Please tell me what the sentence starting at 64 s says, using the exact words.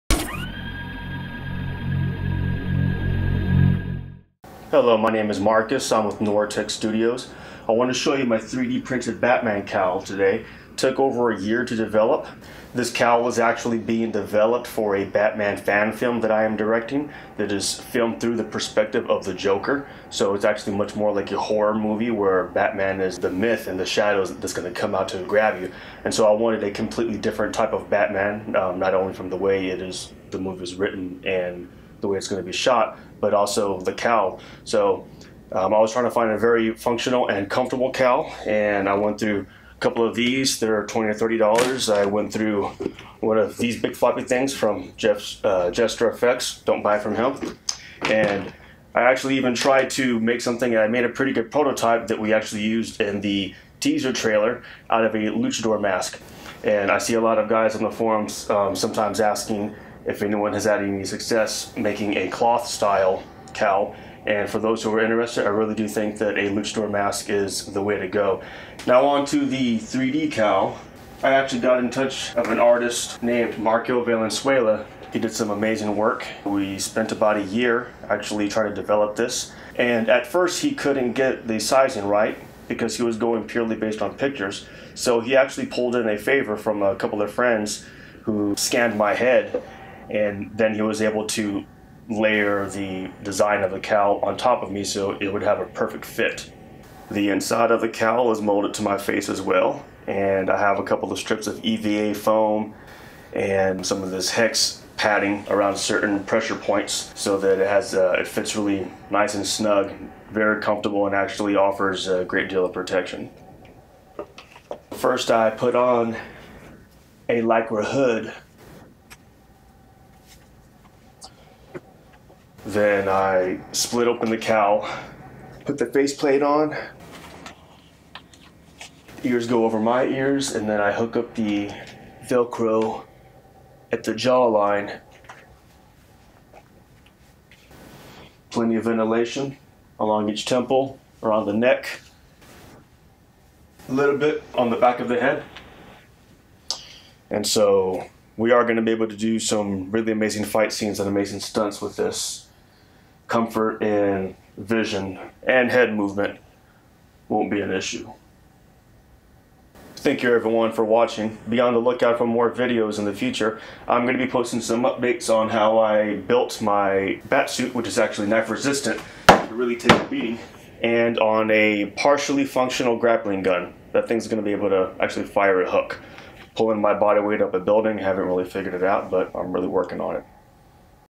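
And for those who are interested, I really do think that a luchador mask is the way to go.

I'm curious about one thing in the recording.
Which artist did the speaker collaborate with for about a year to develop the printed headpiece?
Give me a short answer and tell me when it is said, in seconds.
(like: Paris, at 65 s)
Marco Valenzuela, at 73 s.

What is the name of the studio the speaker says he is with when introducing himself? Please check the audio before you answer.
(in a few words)
NoirTech Studios.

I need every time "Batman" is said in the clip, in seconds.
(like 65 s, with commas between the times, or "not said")
9 s, 15 s, 22 s, 27 s.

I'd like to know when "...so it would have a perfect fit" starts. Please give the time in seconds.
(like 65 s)
94 s.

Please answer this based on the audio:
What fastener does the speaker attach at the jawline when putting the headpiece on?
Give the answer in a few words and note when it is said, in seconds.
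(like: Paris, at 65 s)
Velcro, at 132 s.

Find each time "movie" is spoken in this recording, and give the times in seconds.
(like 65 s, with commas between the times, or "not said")
21 s, 30 s.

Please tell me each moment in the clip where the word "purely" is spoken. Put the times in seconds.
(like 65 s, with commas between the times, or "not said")
83 s.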